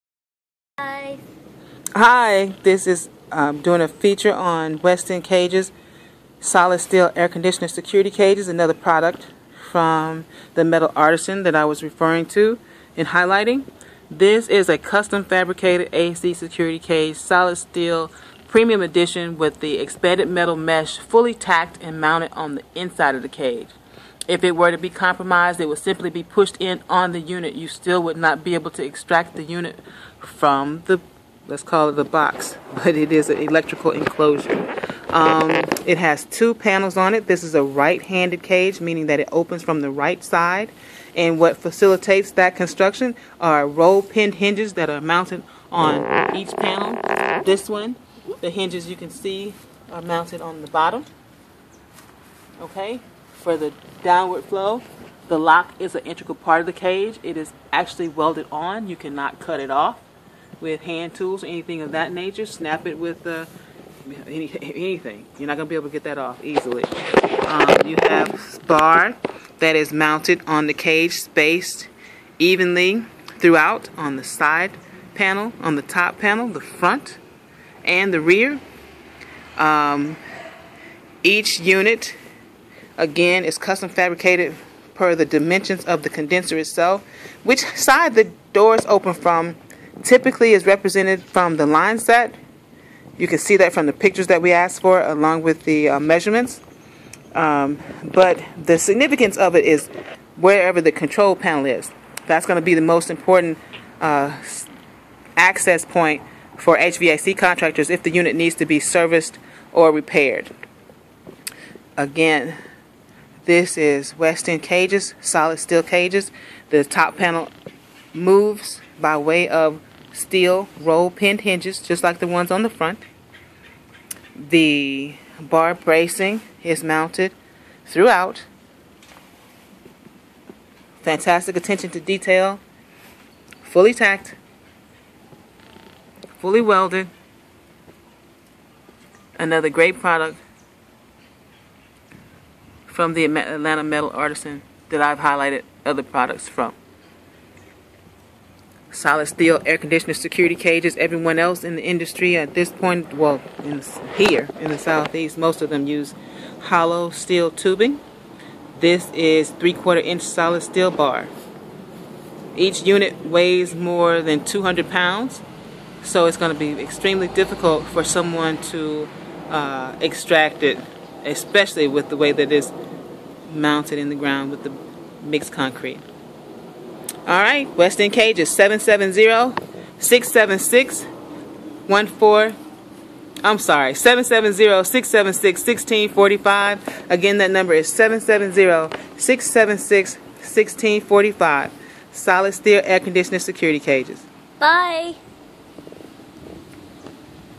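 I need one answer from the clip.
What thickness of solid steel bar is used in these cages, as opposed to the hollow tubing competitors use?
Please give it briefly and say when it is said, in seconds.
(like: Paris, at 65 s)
3/4 inch, at 159 s.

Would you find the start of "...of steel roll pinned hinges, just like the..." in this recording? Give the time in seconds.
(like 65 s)
119 s.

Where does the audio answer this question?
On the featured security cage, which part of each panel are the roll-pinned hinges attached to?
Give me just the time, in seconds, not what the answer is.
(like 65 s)
50 s.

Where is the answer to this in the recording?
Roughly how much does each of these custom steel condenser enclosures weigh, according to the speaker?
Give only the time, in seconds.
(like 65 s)
163 s.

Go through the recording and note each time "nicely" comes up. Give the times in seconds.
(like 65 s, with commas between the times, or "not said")
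not said.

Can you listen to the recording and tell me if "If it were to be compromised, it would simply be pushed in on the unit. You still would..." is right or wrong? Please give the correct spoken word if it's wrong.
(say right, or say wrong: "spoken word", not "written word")
right.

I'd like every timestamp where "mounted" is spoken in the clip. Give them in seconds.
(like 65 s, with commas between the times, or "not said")
22 s, 45 s, 50 s, 69 s, 126 s, 173 s.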